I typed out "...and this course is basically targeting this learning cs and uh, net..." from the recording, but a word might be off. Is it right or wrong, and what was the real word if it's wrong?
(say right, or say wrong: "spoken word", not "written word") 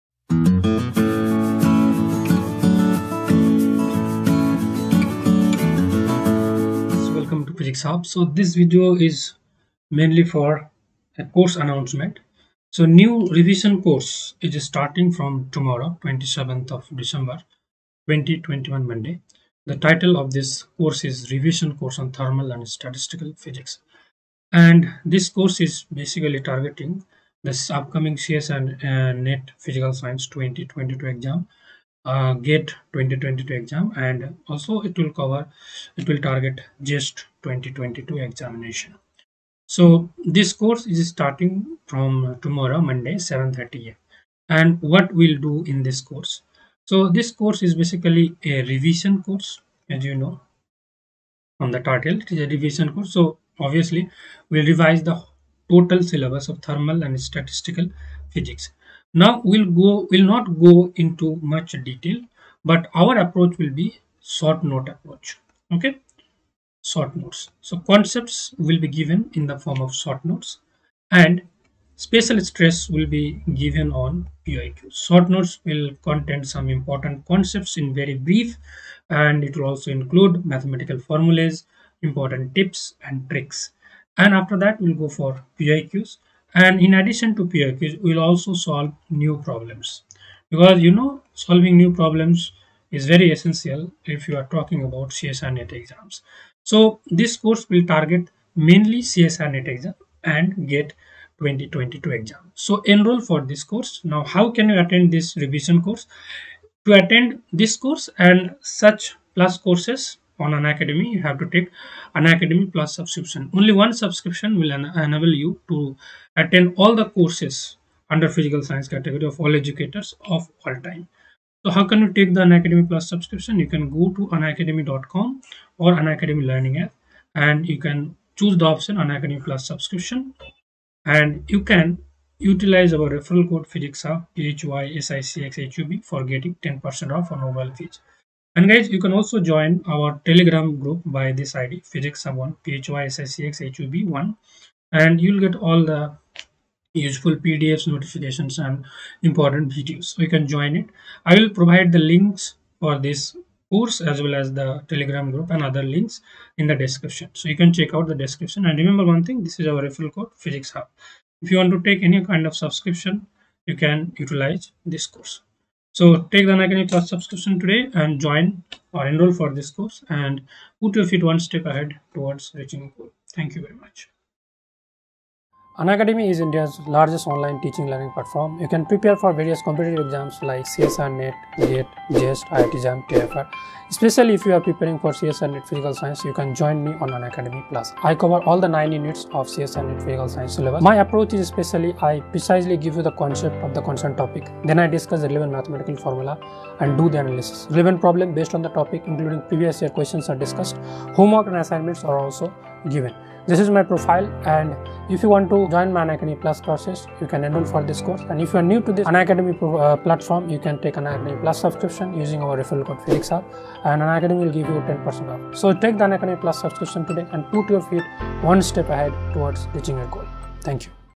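wrong: "upcoming", not "learning".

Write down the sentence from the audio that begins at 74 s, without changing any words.
Short notes will contain some important concepts in very brief, and it will also include mathematical formulas, important tips and tricks.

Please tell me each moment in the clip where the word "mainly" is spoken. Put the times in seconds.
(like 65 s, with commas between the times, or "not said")
9 s, 98 s.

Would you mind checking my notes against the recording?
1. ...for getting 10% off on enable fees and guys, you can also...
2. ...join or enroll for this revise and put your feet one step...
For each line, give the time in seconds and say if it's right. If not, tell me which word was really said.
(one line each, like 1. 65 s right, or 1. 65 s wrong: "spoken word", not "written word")
1. 136 s wrong: "mobile", not "enable"
2. 168 s wrong: "course", not "revise".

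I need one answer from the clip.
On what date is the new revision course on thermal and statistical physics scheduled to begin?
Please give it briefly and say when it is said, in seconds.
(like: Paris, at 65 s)
27 December 2021, at 16 s.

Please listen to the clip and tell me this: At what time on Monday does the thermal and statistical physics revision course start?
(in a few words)
7:30.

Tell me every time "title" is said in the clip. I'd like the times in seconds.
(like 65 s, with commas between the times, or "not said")
19 s, 51 s.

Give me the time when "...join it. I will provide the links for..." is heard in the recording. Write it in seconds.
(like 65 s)
150 s.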